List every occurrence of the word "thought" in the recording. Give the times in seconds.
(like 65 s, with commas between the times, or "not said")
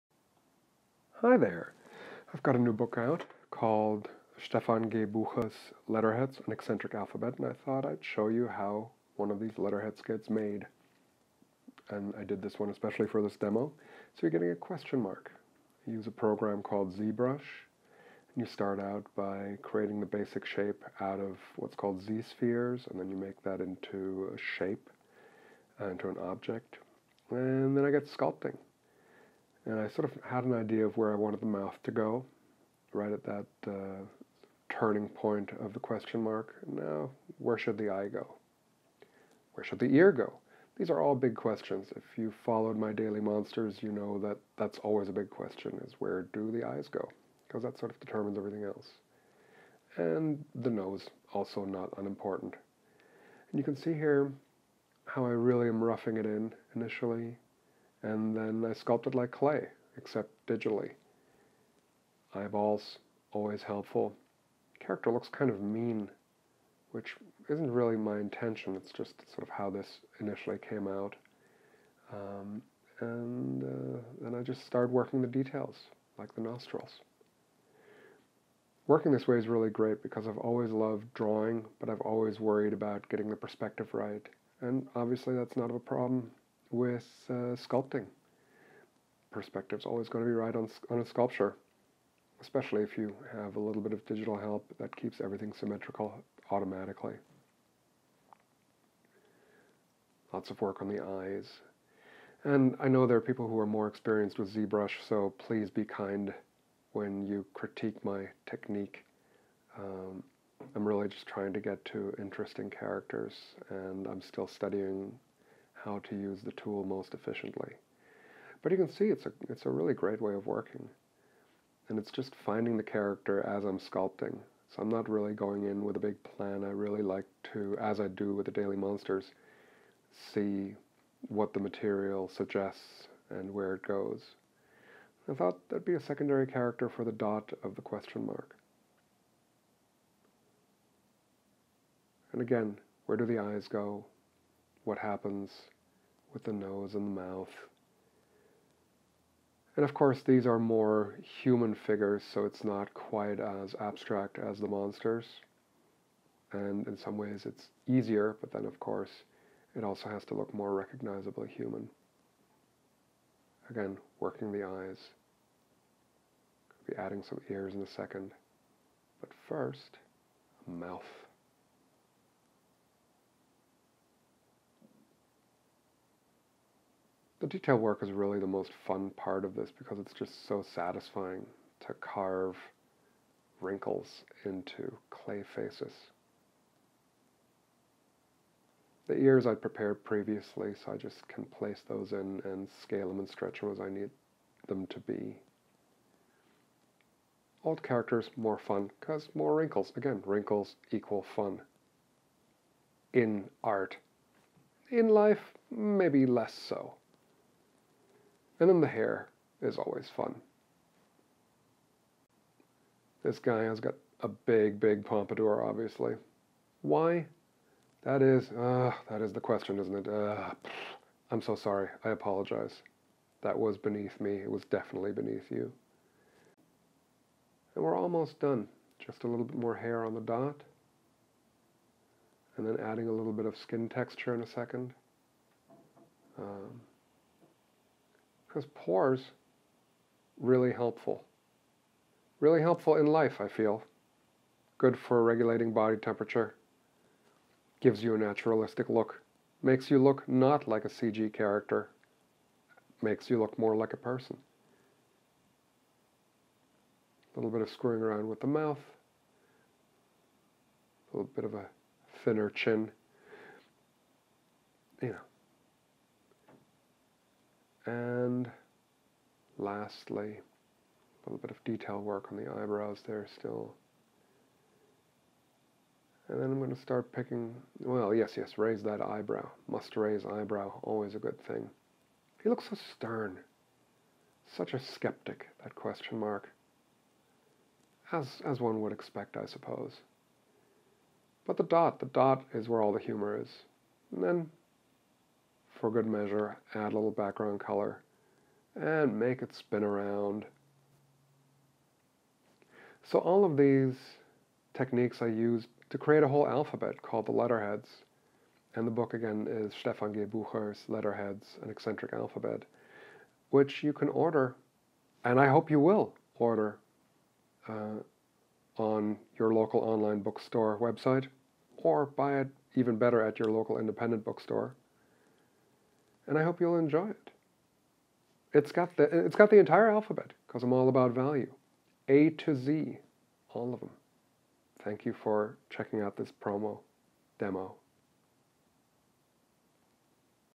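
7 s, 135 s.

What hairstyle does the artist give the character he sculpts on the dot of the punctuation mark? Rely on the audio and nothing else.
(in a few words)
pompadour.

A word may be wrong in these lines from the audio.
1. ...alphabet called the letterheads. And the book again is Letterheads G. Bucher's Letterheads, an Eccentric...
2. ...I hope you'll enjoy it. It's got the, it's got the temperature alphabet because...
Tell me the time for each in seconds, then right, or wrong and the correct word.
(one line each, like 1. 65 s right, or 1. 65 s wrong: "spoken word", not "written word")
1. 306 s wrong: "Stefan", not "Letterheads"
2. 326 s wrong: "entire", not "temperature".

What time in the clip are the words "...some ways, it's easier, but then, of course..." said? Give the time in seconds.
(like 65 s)
156 s.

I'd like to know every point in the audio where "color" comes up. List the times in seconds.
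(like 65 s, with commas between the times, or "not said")
297 s.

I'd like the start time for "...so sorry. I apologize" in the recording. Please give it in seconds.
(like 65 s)
221 s.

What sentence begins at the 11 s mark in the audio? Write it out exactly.
And I did this one especially for this demo.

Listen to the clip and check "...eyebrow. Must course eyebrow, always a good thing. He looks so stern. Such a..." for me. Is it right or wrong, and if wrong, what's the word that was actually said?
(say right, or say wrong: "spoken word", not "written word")
wrong: "raise", not "course".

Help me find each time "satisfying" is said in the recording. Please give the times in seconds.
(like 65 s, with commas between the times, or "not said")
180 s.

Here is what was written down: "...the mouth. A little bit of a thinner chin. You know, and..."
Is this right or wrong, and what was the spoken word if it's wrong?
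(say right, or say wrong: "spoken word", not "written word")
right.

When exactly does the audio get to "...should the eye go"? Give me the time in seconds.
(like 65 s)
37 s.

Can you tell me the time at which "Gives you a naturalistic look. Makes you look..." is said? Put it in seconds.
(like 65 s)
247 s.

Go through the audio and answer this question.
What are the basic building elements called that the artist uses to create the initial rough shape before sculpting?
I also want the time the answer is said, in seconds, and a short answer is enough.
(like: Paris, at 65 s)
Z-spheres, at 22 s.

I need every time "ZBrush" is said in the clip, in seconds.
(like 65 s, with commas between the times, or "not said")
16 s, 104 s.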